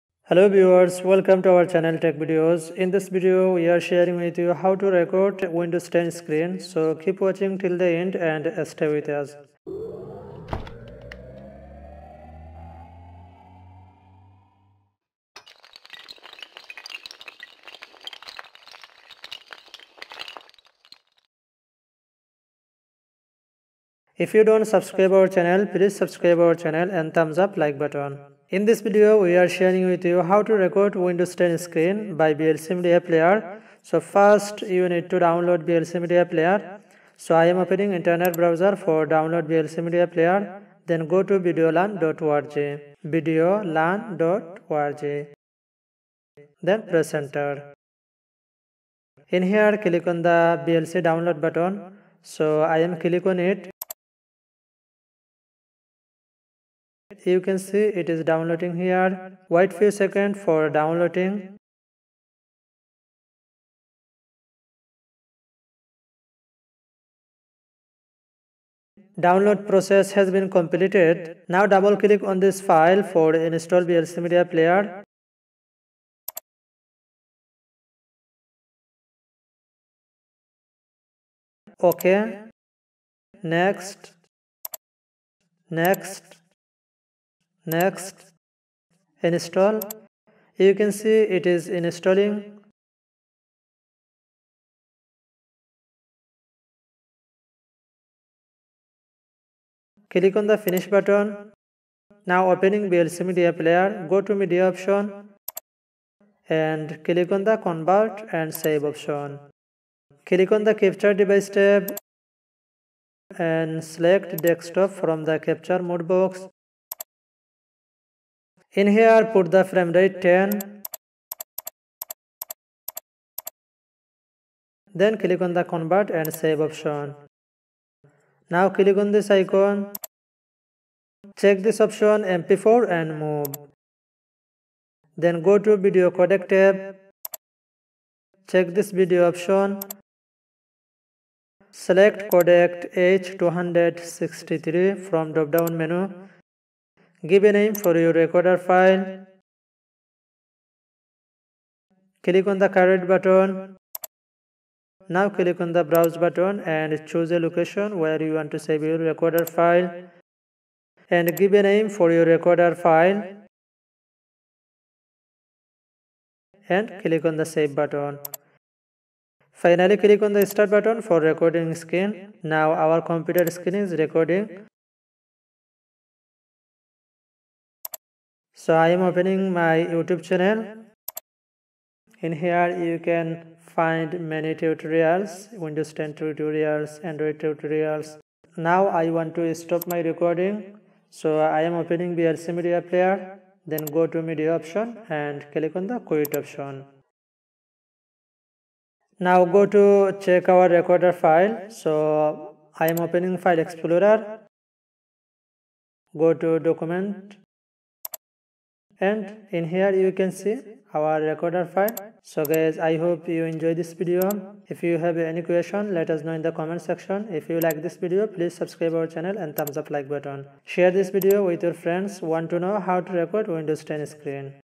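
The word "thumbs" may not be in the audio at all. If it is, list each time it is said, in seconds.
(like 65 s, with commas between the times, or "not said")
27 s, 219 s.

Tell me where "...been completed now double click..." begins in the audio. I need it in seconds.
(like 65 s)
70 s.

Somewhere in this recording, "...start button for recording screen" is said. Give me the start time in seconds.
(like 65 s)
170 s.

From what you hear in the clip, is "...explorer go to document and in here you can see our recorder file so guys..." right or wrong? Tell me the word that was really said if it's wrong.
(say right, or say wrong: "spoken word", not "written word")
right.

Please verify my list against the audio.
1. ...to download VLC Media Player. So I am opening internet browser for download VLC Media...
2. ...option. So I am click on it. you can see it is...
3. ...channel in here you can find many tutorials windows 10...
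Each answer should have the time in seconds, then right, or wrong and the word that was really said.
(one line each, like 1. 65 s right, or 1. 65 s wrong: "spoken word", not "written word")
1. 35 s right
2. 51 s wrong: "button", not "option"
3. 180 s right.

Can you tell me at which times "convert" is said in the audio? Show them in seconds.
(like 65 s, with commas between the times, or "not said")
107 s, 125 s.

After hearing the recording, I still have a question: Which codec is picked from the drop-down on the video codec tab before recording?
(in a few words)
H263.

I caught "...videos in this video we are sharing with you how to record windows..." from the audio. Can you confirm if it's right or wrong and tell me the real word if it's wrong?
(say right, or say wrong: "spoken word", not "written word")
right.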